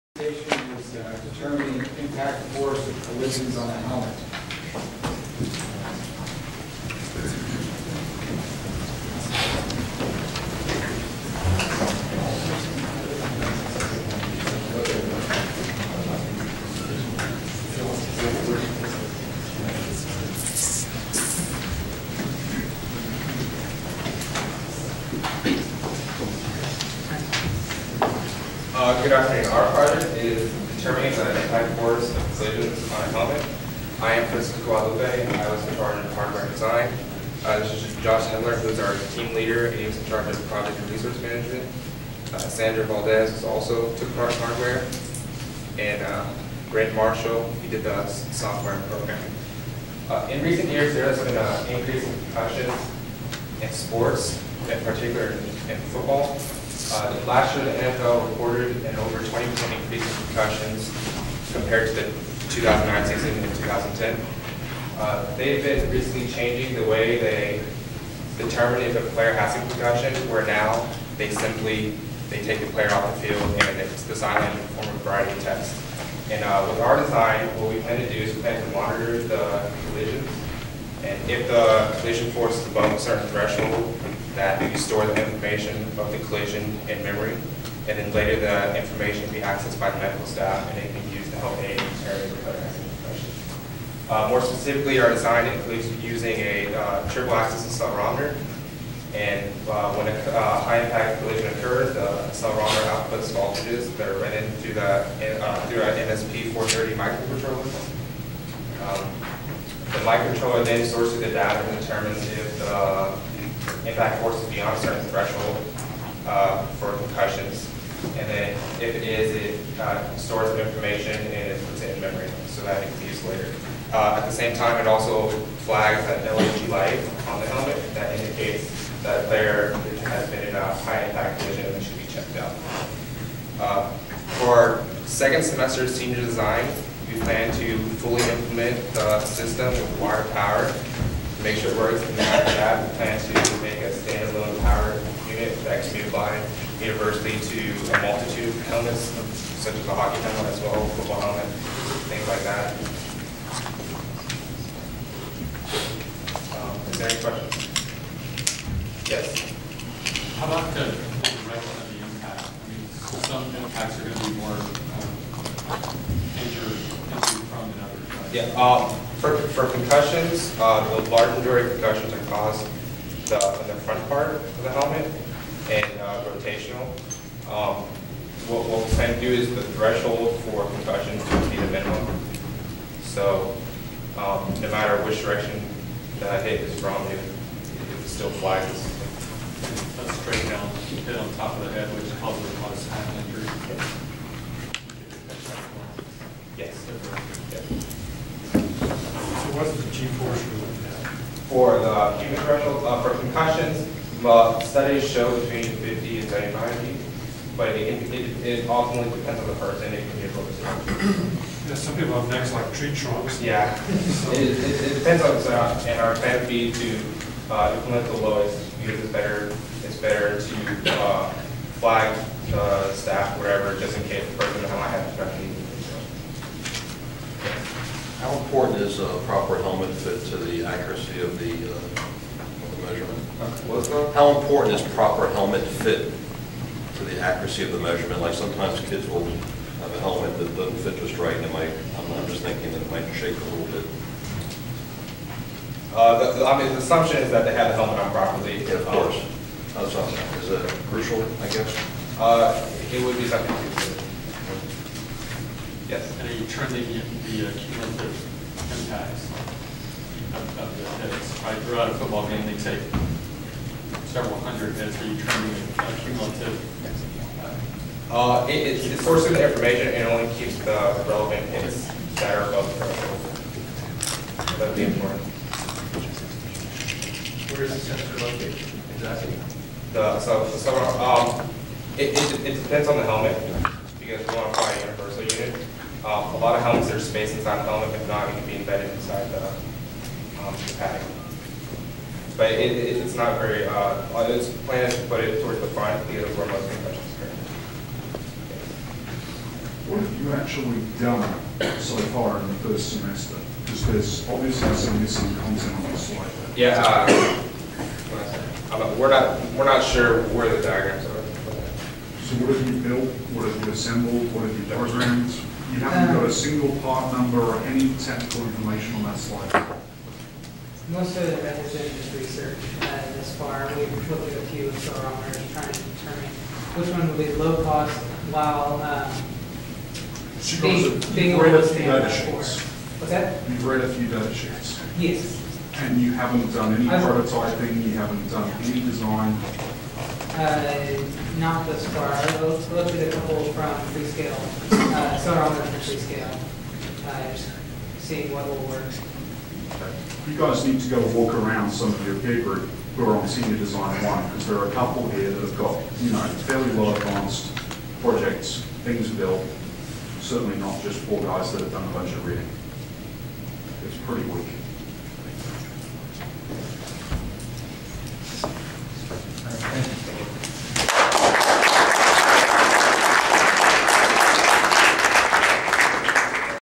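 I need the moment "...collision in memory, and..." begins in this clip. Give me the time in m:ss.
1:26.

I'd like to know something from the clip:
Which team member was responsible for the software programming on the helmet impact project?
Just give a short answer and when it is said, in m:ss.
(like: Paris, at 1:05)
Grant Marshall, at 0:46.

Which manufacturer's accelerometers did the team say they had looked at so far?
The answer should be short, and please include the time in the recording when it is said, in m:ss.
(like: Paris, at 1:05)
Freescale, at 5:43.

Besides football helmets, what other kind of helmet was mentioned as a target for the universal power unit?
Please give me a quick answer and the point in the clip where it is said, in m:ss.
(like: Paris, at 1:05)
hockey helmet, at 2:29.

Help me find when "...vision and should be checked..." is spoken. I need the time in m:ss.
2:11.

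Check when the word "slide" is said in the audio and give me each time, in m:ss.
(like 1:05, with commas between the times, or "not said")
5:05, 5:19.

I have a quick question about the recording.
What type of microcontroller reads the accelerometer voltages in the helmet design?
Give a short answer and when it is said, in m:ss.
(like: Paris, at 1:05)
MSP 430, at 1:46.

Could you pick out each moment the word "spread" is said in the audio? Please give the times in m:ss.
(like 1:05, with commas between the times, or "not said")
not said.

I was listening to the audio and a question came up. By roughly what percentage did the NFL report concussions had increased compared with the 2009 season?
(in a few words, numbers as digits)
over 20%.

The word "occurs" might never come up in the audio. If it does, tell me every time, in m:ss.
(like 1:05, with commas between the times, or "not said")
1:41, 4:57.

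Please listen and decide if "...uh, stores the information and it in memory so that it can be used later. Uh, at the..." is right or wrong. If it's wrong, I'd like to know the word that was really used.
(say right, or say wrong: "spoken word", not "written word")
right.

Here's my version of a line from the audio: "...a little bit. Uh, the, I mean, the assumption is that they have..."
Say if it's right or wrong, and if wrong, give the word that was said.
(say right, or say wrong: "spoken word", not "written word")
right.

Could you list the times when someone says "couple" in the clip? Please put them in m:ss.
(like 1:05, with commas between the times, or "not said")
5:43, 5:54.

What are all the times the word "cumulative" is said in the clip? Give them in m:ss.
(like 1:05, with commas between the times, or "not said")
4:17, 4:25.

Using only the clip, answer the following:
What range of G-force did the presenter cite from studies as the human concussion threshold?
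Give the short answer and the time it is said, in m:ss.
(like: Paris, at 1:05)
50 to 75, at 3:25.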